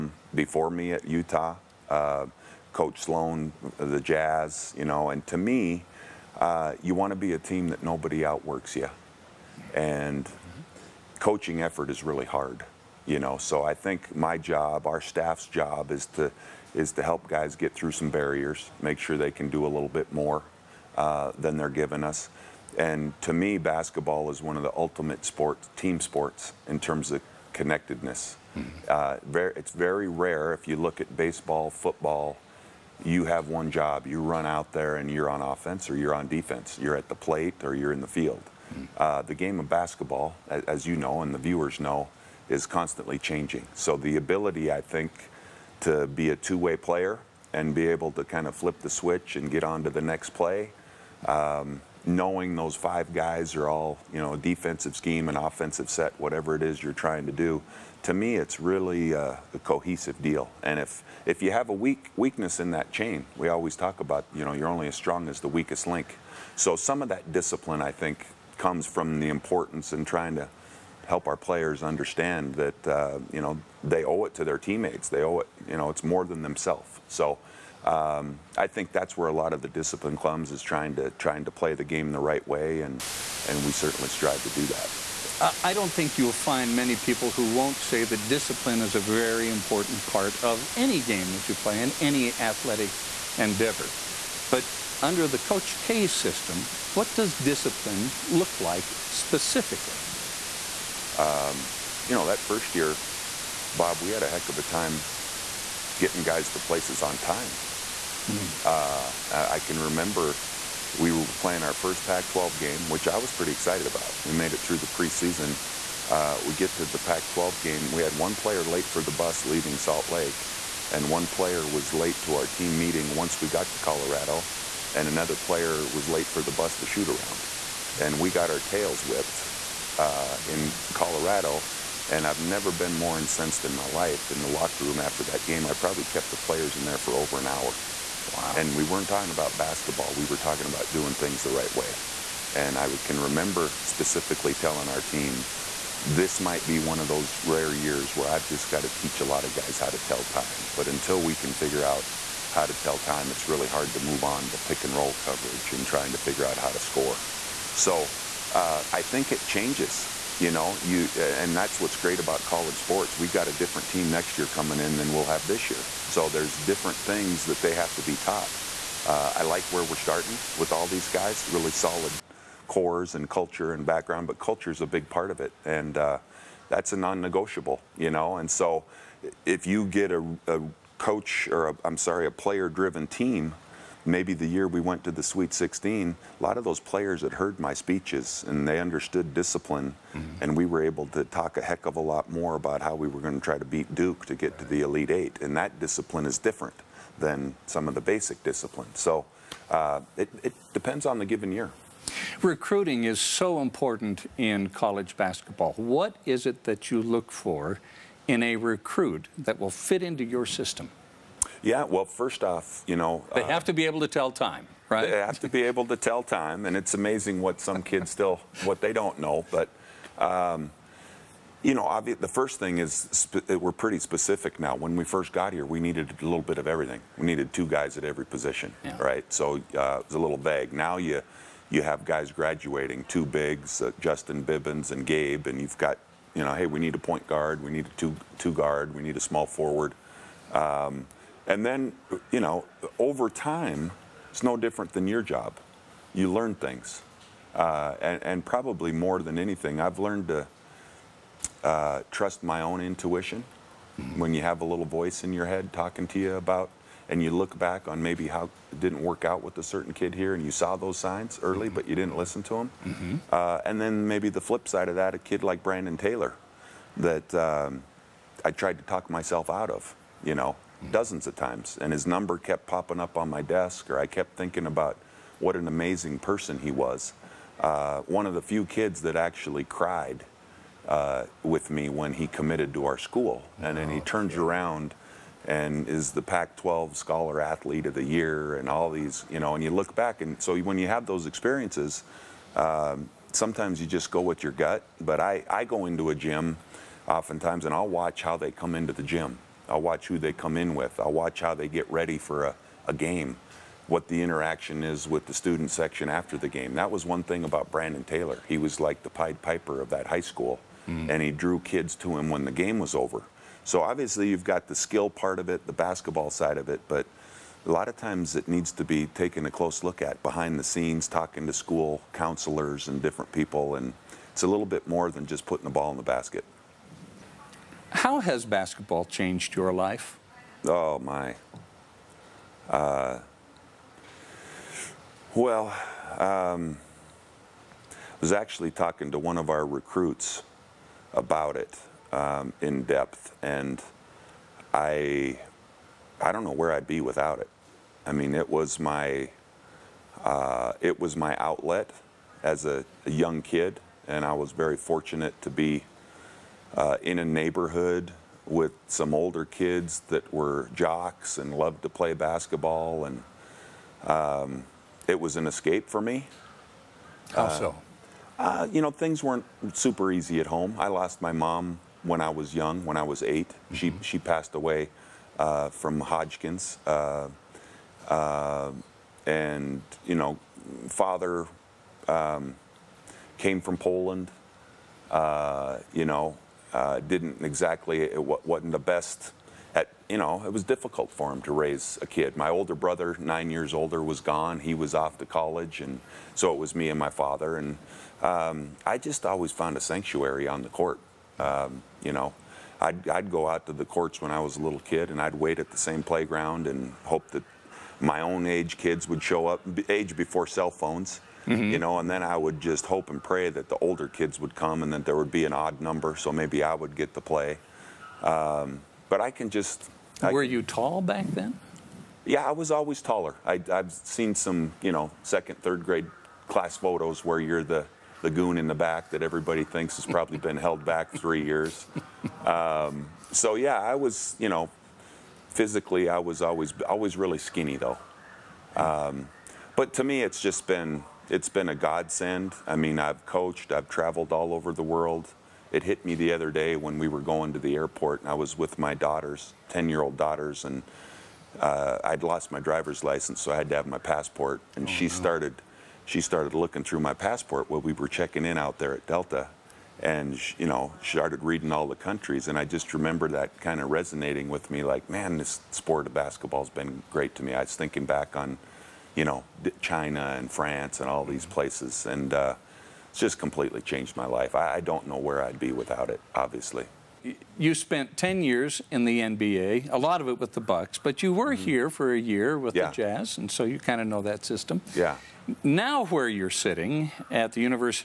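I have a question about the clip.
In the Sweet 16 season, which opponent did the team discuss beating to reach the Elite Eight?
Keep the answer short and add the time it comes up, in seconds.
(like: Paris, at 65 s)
Duke, at 193 s.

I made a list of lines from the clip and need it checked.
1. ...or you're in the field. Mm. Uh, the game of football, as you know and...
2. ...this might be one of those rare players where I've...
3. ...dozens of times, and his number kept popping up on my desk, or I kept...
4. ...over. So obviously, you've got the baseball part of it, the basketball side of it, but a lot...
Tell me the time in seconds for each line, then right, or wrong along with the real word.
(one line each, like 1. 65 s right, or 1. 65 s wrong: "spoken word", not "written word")
1. 37 s wrong: "basketball", not "football"
2. 146 s wrong: "years", not "players"
3. 270 s right
4. 312 s wrong: "skill", not "baseball".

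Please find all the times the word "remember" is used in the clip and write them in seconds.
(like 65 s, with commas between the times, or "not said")
109 s, 143 s, 462 s.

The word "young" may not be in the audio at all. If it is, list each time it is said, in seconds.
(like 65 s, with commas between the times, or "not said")
353 s, 372 s.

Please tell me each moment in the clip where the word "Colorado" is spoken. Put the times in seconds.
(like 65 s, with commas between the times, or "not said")
123 s, 130 s.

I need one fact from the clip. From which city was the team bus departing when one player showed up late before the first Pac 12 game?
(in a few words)
Salt Lake.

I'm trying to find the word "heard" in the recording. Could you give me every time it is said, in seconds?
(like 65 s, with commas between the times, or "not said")
187 s.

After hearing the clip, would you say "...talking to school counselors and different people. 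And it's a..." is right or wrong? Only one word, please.
right.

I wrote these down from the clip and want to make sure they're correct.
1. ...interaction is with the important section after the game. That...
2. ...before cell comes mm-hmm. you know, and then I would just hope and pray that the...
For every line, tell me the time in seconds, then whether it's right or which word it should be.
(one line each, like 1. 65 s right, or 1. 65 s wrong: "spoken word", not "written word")
1. 304 s wrong: "student", not "important"
2. 410 s wrong: "phones", not "comes".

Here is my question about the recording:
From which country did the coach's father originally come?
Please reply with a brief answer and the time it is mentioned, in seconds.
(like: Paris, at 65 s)
Poland, at 383 s.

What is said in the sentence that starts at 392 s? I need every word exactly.
My older brother, nine years older, was gone.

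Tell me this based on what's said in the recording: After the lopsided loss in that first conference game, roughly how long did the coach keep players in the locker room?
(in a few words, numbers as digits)
Over an hour.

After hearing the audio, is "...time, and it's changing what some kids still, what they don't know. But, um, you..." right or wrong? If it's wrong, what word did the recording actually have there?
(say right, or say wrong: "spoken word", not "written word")
wrong: "amazing", not "changing".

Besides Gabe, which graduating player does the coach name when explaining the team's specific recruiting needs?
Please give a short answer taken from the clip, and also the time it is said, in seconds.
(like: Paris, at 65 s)
Justin Bibbins, at 233 s.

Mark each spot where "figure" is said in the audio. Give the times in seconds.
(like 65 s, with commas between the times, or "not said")
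151 s, 156 s.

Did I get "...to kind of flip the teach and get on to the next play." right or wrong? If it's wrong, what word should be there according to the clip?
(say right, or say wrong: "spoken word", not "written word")
wrong: "switch", not "teach".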